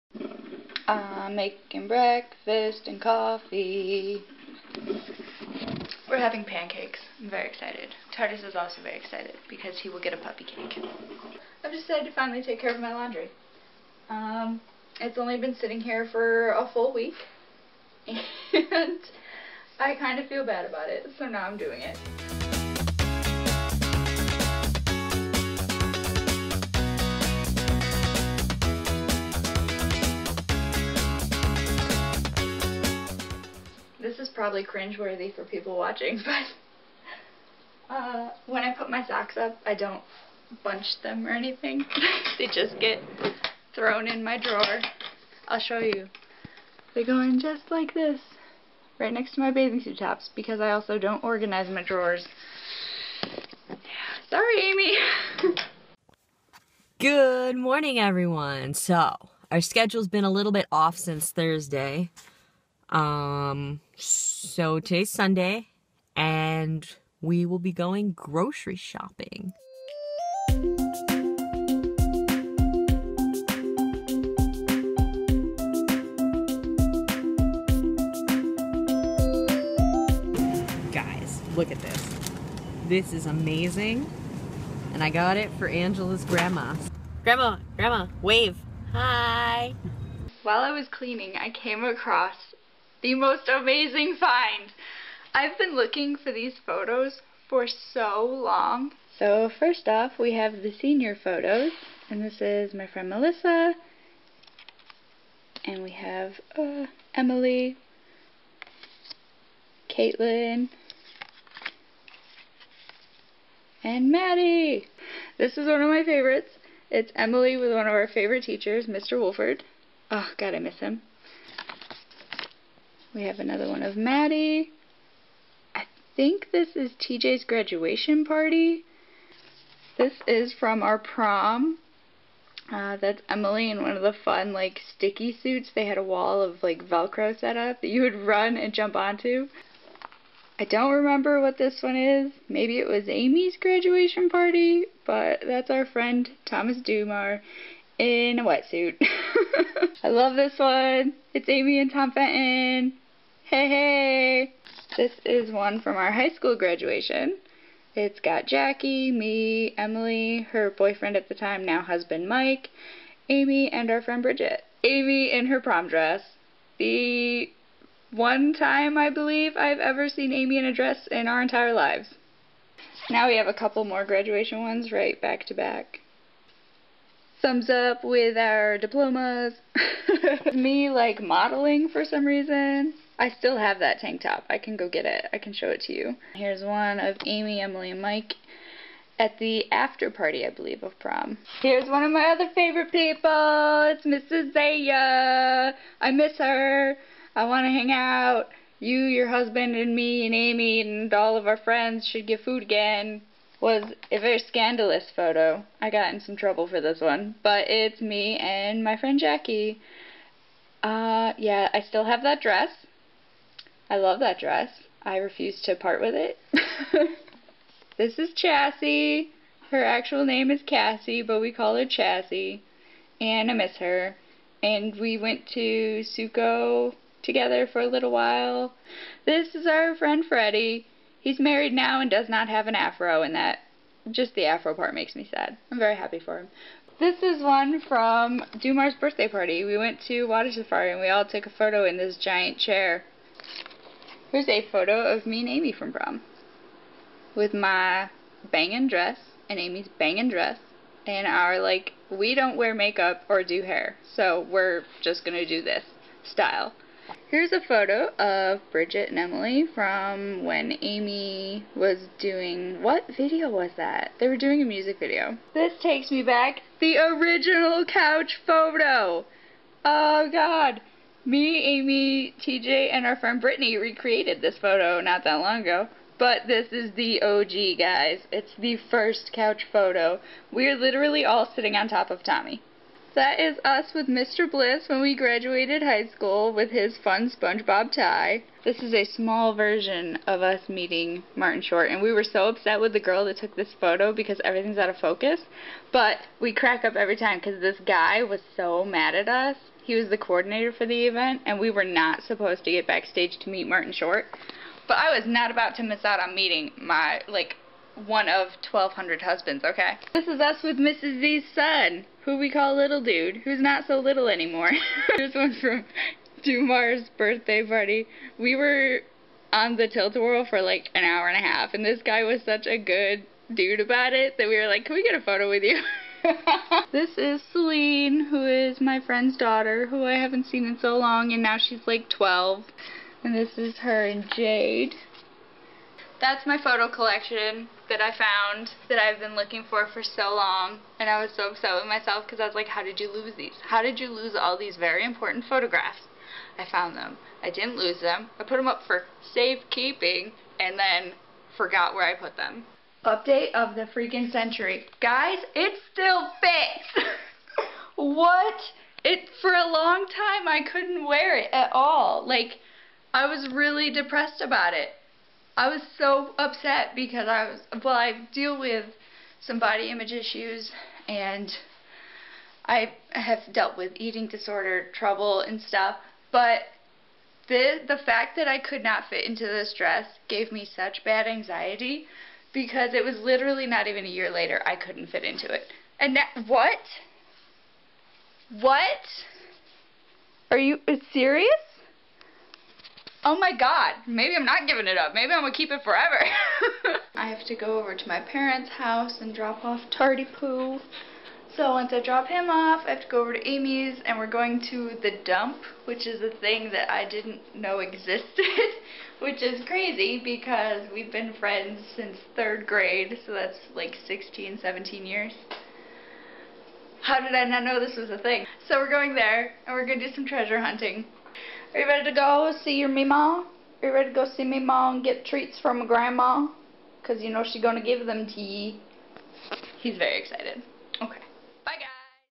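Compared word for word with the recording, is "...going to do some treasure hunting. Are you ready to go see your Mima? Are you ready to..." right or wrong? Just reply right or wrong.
right.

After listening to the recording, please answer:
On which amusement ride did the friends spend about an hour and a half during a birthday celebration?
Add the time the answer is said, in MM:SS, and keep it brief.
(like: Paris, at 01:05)
tilt-a-whirl, at 05:19.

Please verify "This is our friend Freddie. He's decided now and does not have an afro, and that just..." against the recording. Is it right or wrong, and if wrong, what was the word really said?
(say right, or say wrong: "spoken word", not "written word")
wrong: "married", not "decided".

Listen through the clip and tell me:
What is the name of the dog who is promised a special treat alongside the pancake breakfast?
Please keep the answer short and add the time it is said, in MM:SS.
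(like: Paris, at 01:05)
Tardis, at 00:08.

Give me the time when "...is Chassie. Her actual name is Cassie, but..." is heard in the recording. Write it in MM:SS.
03:38.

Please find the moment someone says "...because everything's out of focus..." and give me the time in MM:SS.
04:54.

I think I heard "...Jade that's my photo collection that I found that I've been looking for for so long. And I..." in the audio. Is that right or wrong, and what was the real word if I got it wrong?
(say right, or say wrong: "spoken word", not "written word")
right.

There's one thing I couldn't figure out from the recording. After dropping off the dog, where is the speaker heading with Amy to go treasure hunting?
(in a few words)
the dump.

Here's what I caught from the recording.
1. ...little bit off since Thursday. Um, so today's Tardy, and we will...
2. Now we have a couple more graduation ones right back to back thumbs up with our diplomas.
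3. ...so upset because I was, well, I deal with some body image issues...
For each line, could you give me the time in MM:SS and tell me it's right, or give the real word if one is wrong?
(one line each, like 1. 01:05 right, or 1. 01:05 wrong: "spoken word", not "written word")
1. 01:00 wrong: "Sunday", not "Tardy"
2. 02:53 right
3. 06:05 right.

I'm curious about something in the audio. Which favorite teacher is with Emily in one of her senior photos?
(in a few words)
Mr. Wolford.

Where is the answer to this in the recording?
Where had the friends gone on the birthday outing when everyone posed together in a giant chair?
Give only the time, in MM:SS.
04:00.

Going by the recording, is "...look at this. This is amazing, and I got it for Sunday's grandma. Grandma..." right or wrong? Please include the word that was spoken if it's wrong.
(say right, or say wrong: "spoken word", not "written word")
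wrong: "Angela", not "Sunday".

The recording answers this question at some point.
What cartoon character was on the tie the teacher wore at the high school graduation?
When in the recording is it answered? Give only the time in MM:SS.
04:47.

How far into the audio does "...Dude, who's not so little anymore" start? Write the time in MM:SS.
05:13.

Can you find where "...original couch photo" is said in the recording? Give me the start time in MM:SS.
04:26.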